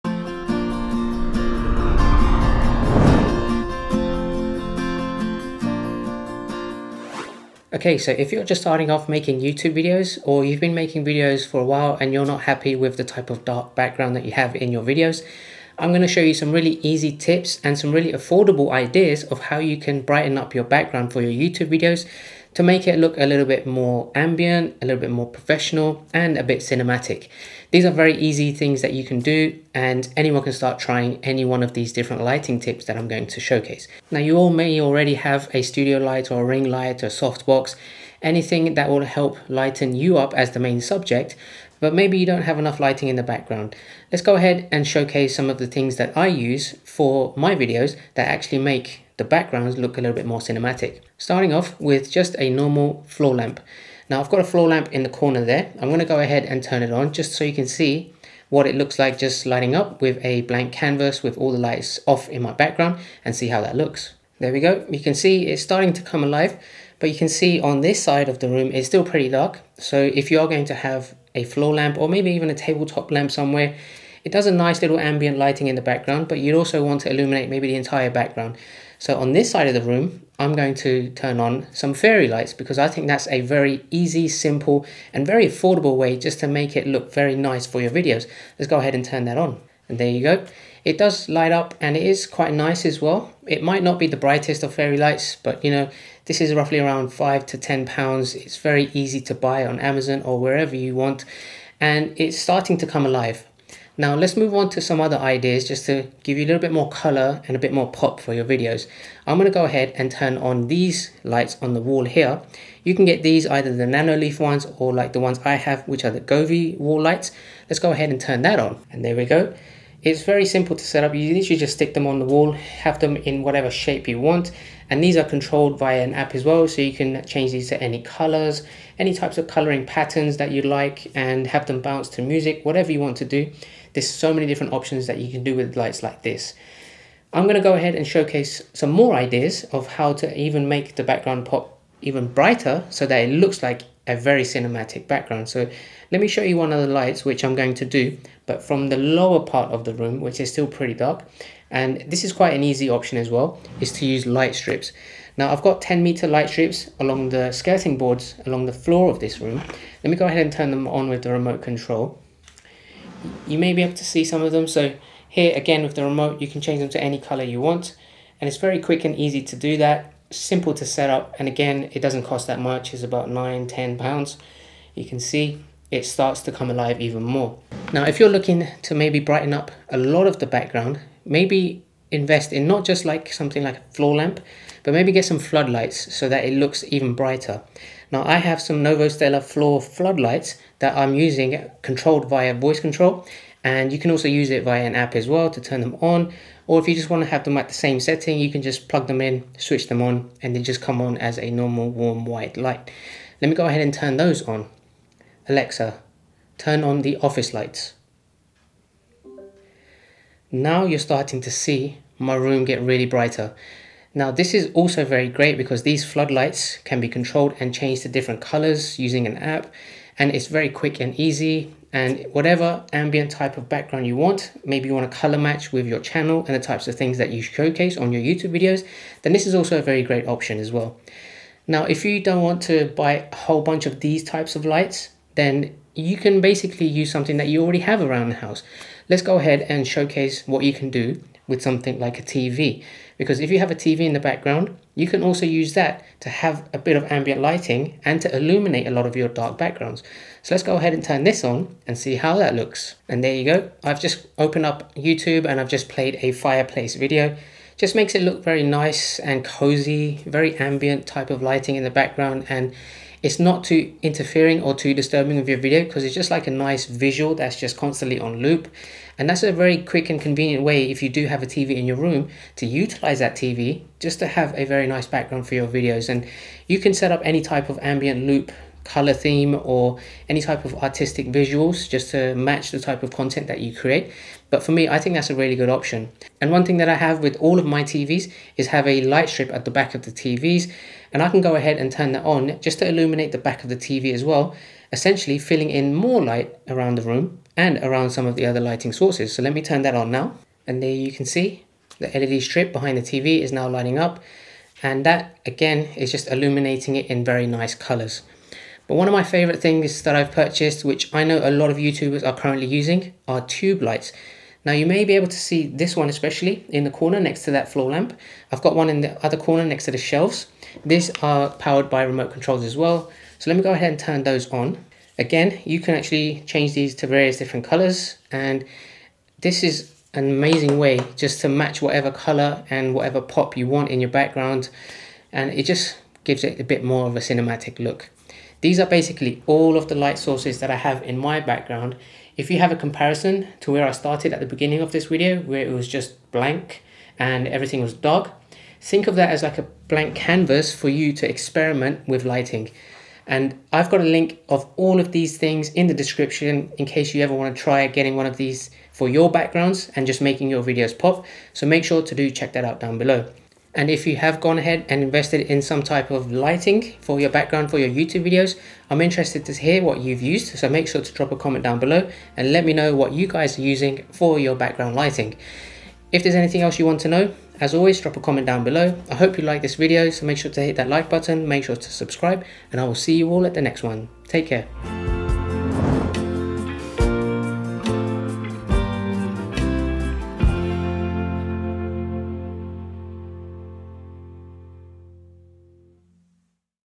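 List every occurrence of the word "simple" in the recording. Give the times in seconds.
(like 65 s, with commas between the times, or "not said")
84 s, 120 s, 170 s.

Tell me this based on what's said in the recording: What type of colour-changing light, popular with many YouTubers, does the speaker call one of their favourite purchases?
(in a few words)
Tube lights.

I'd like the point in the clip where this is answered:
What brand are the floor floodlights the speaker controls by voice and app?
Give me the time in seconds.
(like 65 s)
188 s.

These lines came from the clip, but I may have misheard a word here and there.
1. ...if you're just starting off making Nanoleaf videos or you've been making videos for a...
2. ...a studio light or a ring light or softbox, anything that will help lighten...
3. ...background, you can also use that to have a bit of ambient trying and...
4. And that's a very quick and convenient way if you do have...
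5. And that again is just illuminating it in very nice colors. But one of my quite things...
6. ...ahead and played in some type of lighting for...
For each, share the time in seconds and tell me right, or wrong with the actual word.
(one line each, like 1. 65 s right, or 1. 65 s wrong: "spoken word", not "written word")
1. 8 s wrong: "YouTube", not "Nanoleaf"
2. 35 s right
3. 244 s wrong: "lighting", not "trying"
4. 269 s right
5. 304 s wrong: "favorite", not "quite"
6. 364 s wrong: "invested", not "played".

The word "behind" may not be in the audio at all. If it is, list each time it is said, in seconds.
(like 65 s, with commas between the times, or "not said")
302 s.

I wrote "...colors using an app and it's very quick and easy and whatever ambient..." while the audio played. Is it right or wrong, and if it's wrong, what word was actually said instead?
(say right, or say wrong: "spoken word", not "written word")
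right.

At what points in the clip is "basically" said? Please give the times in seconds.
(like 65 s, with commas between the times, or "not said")
236 s, 338 s.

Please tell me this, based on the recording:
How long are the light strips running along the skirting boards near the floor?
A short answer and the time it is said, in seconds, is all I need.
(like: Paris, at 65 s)
10 meters, at 155 s.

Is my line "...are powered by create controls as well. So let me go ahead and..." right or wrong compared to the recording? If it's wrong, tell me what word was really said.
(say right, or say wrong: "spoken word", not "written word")
wrong: "remote", not "create".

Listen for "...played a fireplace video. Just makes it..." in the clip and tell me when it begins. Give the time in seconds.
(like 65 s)
255 s.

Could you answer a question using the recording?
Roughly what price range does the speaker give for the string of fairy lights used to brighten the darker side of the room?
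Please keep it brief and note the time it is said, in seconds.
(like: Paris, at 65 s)
5 to 10 pounds, at 97 s.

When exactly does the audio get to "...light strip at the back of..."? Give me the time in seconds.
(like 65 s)
289 s.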